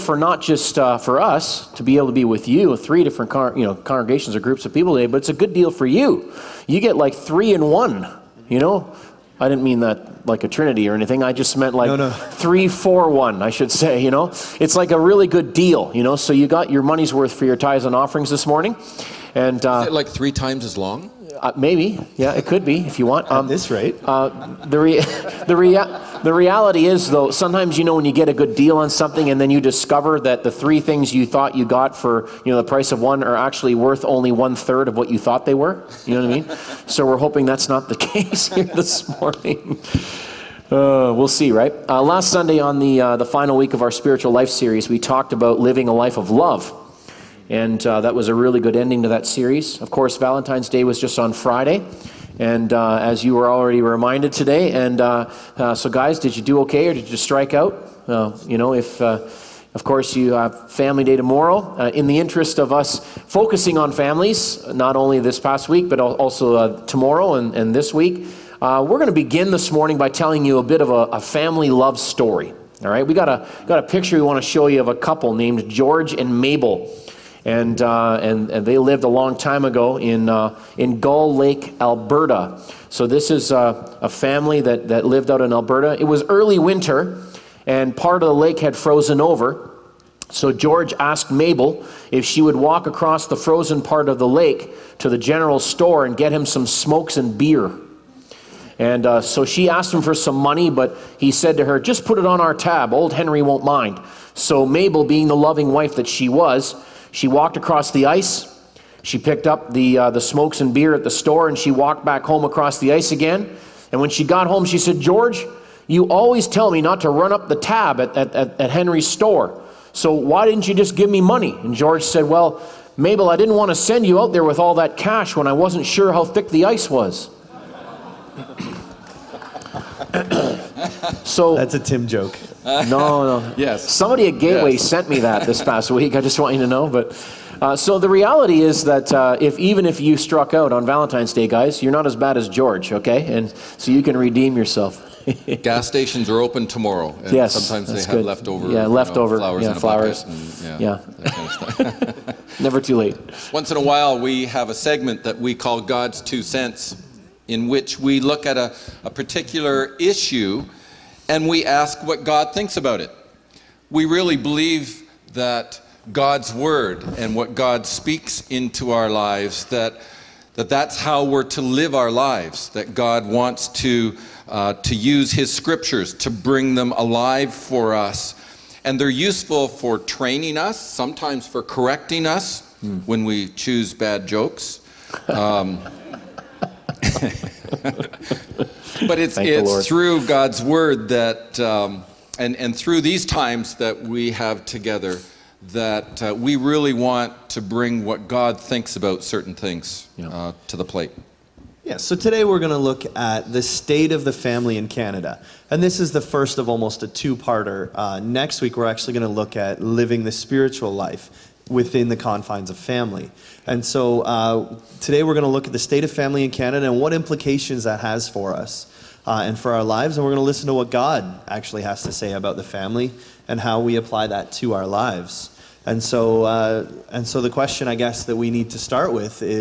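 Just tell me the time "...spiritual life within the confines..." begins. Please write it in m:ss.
3:30.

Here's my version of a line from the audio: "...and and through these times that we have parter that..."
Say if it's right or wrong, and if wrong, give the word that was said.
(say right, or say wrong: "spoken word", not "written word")
wrong: "together", not "parter".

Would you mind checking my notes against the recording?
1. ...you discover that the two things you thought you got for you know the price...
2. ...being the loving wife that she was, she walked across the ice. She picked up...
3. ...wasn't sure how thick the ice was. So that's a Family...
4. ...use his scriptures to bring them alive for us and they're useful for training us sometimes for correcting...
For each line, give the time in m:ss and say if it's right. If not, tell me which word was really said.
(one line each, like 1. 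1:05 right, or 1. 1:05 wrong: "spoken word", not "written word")
1. 0:29 wrong: "three", not "two"
2. 1:45 right
3. 2:05 wrong: "Tim", not "Family"
4. 2:54 right.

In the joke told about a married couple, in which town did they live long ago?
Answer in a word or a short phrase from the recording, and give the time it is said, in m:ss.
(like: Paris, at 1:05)
Gull Lake, Alberta, at 1:20.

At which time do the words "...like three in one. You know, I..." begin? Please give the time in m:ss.
0:06.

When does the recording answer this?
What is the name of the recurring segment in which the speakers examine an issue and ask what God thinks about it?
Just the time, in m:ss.
2:35.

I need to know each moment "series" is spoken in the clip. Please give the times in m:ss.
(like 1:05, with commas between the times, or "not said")
0:44, 0:49.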